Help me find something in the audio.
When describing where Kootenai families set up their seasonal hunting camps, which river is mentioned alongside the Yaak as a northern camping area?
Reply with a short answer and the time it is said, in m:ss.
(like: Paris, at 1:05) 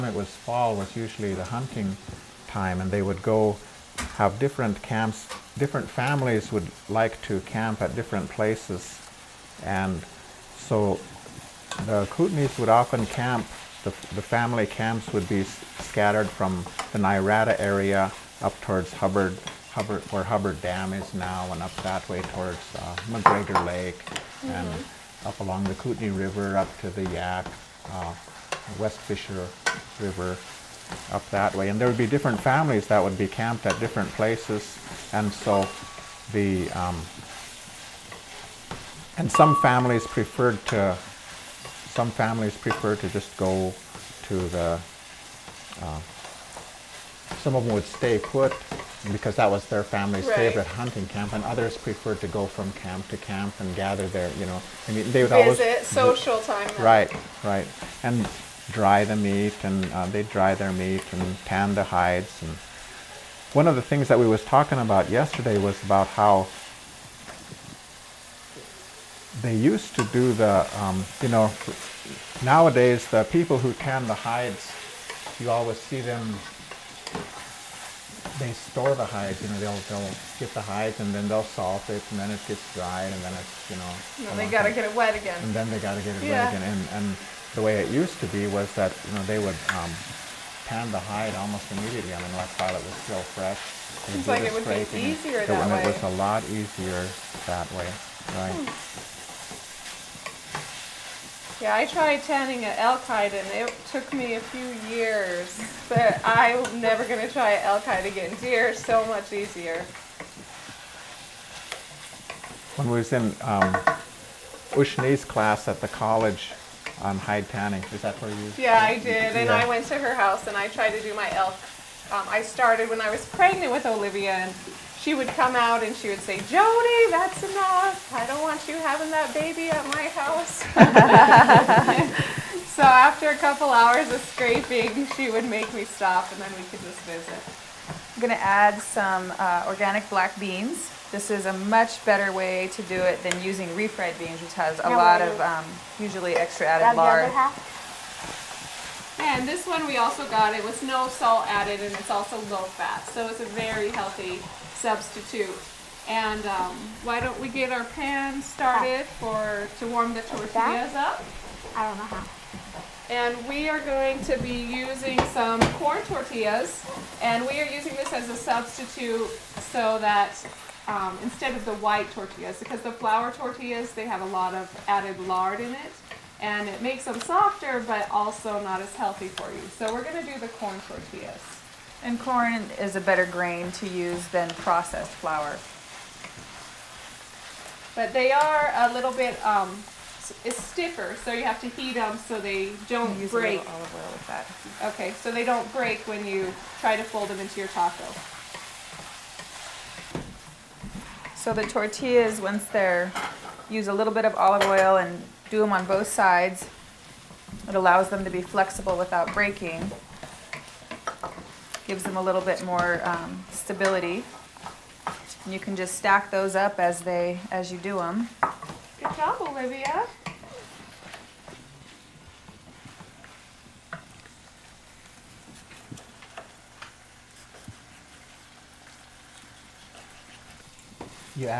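West Fisher River, at 0:28.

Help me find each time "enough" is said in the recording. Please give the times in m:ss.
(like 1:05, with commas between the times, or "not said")
2:07.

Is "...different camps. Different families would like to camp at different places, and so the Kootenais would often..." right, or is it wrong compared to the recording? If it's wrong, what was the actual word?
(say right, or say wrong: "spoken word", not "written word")
right.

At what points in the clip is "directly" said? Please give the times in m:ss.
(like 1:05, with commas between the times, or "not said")
not said.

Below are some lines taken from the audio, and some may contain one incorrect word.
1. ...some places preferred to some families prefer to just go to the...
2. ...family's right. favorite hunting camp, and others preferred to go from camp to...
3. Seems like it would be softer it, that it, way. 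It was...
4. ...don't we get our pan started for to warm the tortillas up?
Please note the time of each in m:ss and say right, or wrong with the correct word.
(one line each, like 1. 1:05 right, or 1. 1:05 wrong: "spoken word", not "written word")
1. 0:39 wrong: "families", not "places"
2. 0:49 right
3. 1:34 wrong: "easier", not "softer"
4. 2:37 right.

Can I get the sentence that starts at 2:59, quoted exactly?
So we're going to do the corn tortillas.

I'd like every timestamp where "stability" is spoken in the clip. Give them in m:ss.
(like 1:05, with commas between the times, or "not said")
3:33.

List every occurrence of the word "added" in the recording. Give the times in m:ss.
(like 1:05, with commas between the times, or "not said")
2:26, 2:31, 2:54.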